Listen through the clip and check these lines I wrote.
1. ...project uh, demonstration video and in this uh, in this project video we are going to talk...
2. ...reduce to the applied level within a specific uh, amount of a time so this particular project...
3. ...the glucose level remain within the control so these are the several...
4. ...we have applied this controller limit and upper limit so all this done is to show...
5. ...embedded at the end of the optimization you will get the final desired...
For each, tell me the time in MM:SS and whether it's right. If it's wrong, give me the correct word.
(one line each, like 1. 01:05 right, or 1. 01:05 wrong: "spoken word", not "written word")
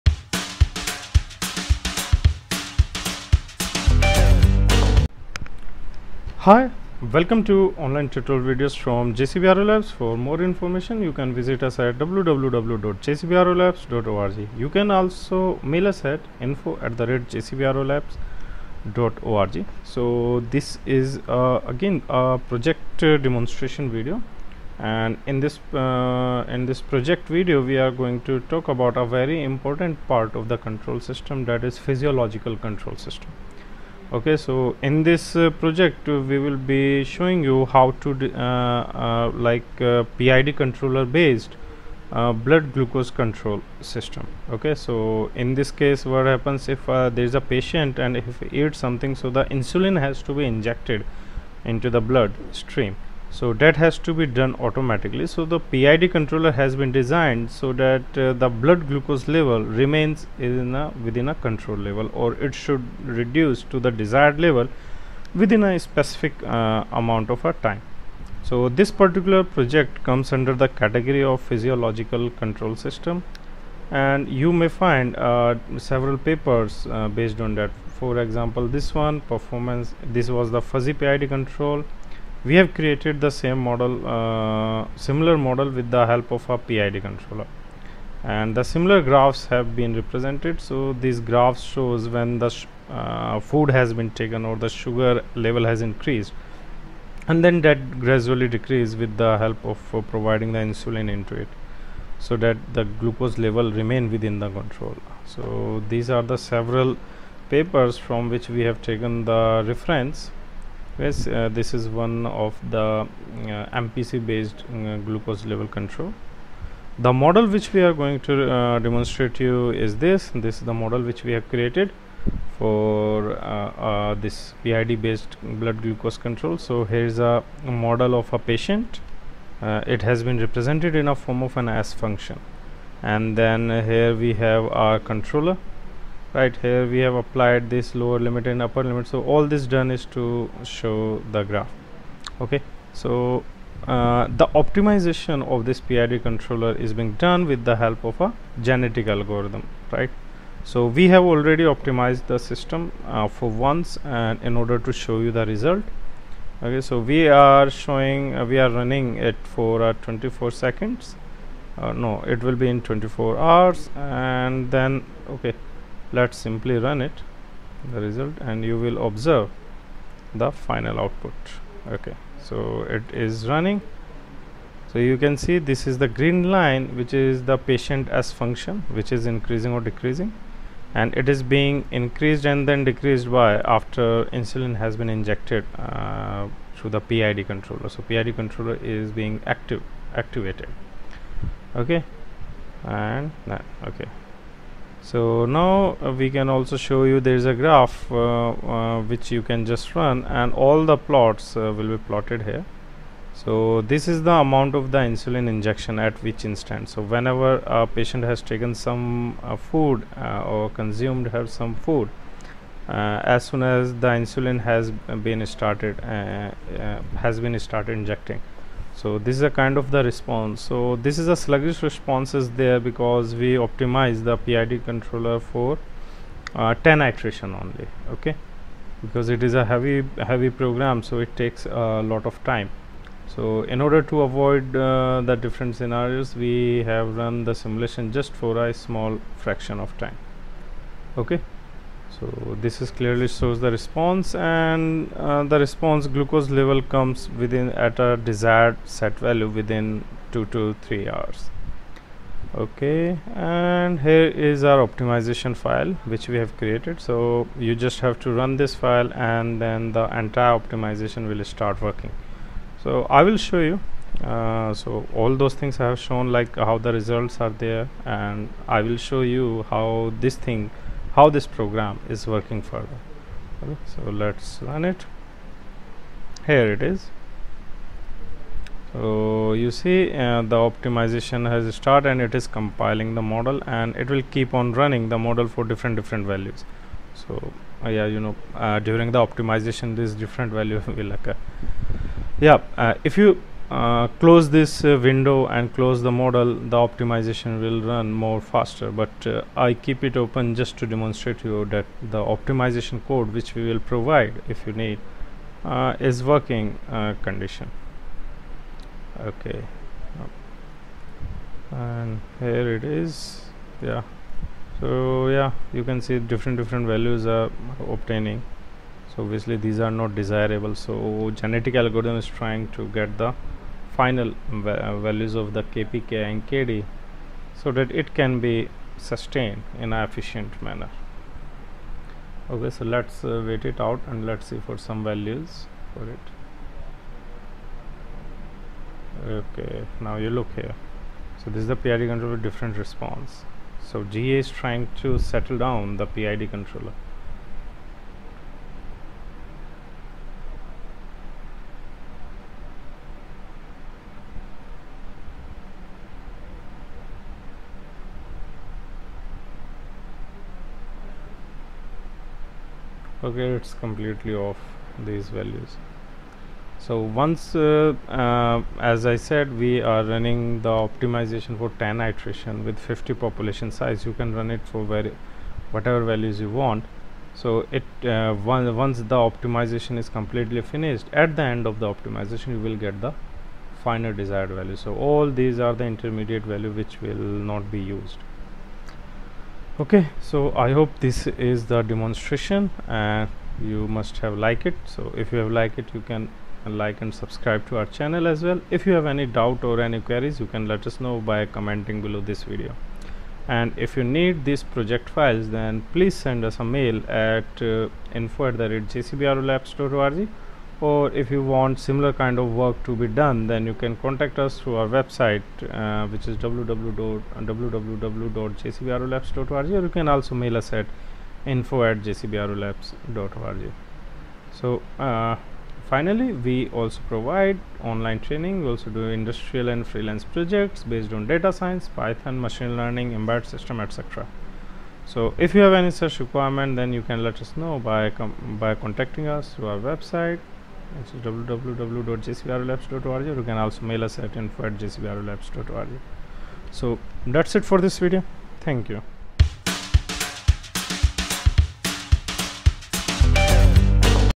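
1. 00:22 right
2. 01:03 wrong: "desired", not "applied"
3. 01:42 right
4. 02:16 wrong: "lower", not "controller"
5. 06:20 wrong: "finished", not "embedded".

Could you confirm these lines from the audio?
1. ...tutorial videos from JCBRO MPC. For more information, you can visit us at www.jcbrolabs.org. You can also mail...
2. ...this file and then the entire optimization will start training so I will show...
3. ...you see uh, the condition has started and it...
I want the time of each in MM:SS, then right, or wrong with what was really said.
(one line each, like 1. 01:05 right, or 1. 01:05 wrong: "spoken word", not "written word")
1. 00:08 wrong: "Labs", not "MPC"
2. 04:18 wrong: "working", not "training"
3. 04:39 wrong: "optimization", not "condition".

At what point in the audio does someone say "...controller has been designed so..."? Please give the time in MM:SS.
00:56.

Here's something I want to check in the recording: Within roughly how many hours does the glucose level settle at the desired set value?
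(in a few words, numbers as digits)
2 to 3 hours.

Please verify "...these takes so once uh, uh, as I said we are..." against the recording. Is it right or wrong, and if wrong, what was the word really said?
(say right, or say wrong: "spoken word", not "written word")
wrong: "values", not "takes".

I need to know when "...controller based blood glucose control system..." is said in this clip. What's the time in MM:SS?
00:40.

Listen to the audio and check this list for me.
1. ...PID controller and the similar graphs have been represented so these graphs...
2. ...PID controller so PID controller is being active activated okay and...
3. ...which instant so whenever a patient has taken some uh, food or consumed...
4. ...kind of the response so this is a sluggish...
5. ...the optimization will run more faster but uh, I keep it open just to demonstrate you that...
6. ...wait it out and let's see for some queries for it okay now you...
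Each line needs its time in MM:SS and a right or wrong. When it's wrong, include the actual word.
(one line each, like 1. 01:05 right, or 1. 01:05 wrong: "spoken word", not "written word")
1. 01:26 right
2. 03:06 right
3. 03:26 right
4. 03:39 right
5. 04:56 right
6. 05:33 wrong: "values", not "queries".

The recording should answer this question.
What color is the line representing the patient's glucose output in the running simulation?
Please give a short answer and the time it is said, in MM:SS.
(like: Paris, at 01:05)
green, at 02:56.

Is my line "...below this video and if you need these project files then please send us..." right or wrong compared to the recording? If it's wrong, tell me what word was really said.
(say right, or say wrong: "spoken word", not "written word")
right.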